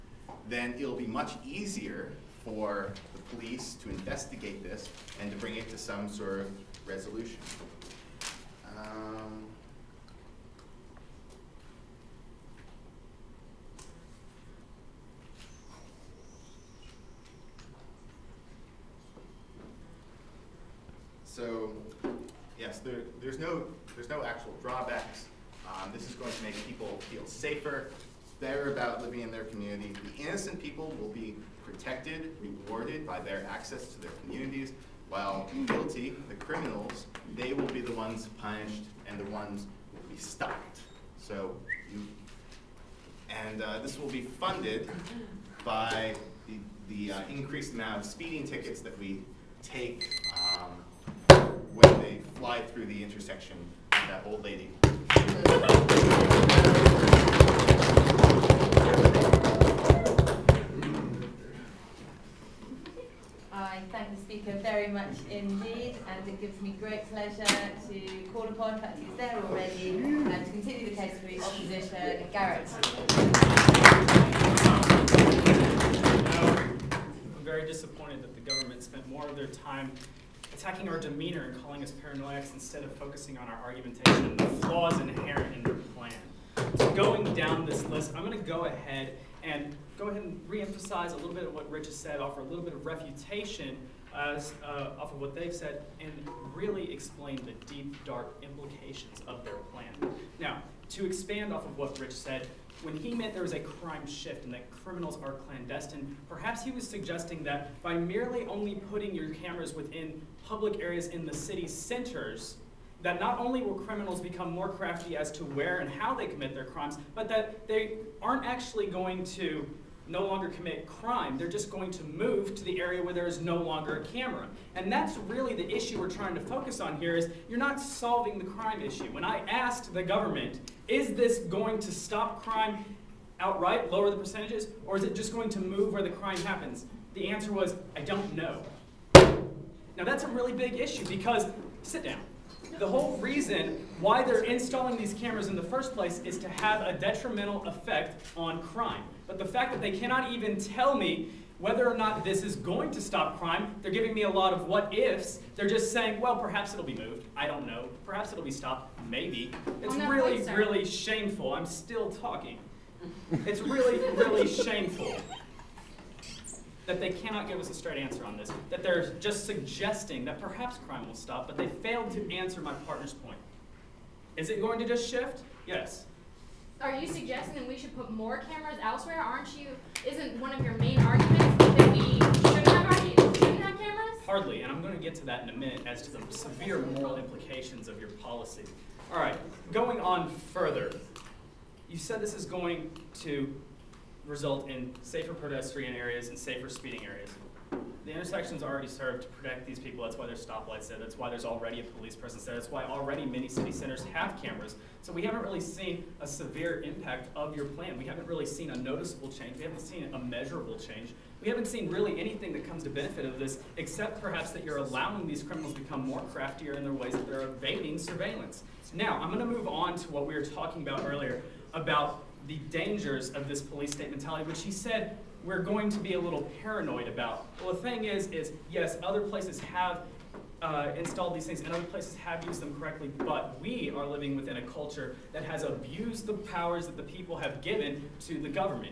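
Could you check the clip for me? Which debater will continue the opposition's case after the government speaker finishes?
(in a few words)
Garrett.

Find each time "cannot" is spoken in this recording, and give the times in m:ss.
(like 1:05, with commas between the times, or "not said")
2:29, 2:47.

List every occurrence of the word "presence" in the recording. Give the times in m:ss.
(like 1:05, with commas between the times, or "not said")
3:22.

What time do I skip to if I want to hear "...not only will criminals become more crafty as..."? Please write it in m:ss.
1:53.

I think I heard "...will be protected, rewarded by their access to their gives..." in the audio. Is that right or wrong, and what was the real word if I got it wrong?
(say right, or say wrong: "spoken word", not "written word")
wrong: "communities", not "gives".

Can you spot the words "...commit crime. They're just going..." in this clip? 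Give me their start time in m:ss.
2:00.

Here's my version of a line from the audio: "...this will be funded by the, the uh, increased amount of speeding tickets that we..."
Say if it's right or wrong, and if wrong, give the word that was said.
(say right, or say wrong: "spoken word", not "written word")
right.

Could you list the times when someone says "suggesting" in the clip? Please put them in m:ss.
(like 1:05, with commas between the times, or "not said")
1:46, 2:49, 2:57.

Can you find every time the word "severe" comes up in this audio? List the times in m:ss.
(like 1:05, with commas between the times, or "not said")
3:06, 3:26.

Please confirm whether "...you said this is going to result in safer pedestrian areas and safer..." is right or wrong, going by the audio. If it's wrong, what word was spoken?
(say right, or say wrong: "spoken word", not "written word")
right.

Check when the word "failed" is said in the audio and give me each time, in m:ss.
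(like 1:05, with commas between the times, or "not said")
2:51.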